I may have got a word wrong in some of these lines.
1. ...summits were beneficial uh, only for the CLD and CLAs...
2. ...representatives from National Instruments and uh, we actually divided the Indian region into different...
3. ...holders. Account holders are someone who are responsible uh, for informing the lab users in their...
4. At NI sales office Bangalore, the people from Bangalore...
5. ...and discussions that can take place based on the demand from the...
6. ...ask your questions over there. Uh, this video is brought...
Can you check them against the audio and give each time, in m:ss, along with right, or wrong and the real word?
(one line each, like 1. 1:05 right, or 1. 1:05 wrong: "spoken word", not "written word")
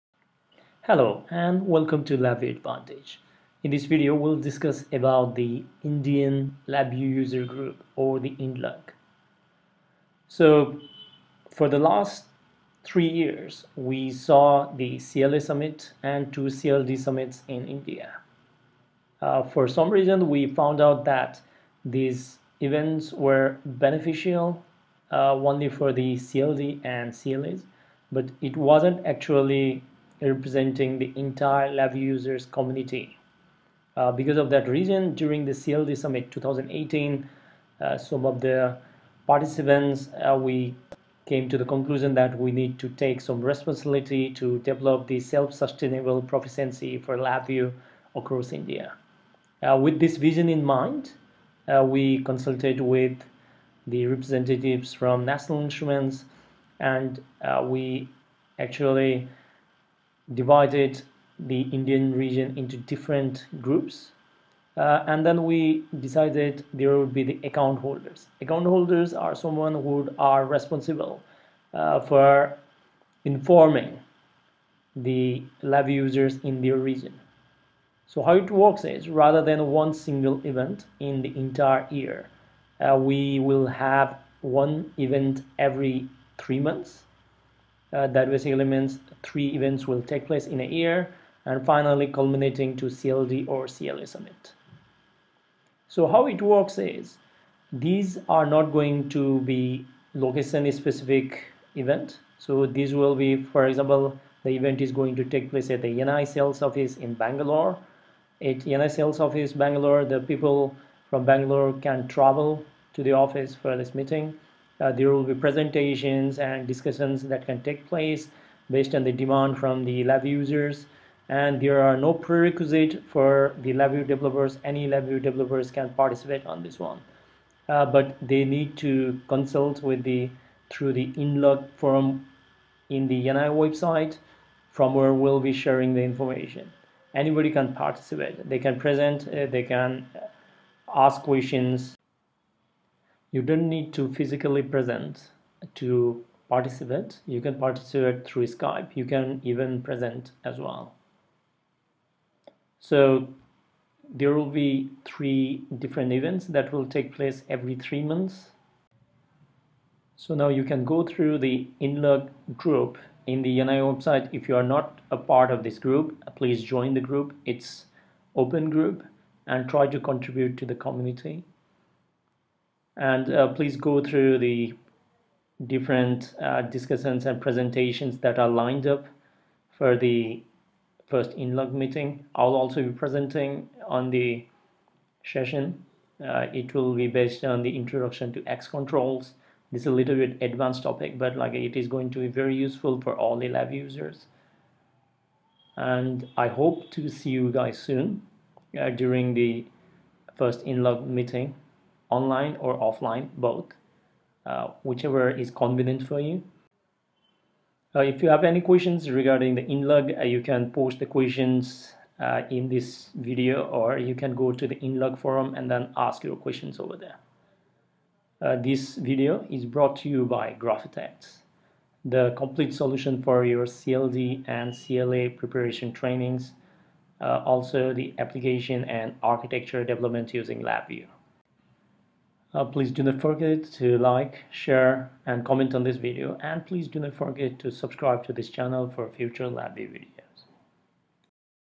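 1. 0:22 wrong: "events", not "summits"
2. 0:54 right
3. 1:07 right
4. 1:48 right
5. 1:56 right
6. 3:35 right.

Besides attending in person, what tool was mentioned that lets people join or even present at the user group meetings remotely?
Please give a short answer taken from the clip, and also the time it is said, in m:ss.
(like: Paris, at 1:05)
Skype, at 2:28.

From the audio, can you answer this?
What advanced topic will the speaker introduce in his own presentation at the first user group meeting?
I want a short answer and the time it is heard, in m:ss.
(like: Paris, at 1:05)
XControls, at 3:08.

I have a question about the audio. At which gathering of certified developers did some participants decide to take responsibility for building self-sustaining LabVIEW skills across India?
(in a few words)
CLD Summit 2018.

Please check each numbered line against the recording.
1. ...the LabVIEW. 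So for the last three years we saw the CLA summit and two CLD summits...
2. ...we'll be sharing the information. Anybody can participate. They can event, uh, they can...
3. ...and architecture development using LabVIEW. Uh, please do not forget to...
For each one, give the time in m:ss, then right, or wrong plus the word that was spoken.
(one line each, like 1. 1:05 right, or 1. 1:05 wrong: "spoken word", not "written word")
1. 0:08 wrong: "INDLUG", not "LabVIEW"
2. 2:15 wrong: "present", not "event"
3. 3:48 right.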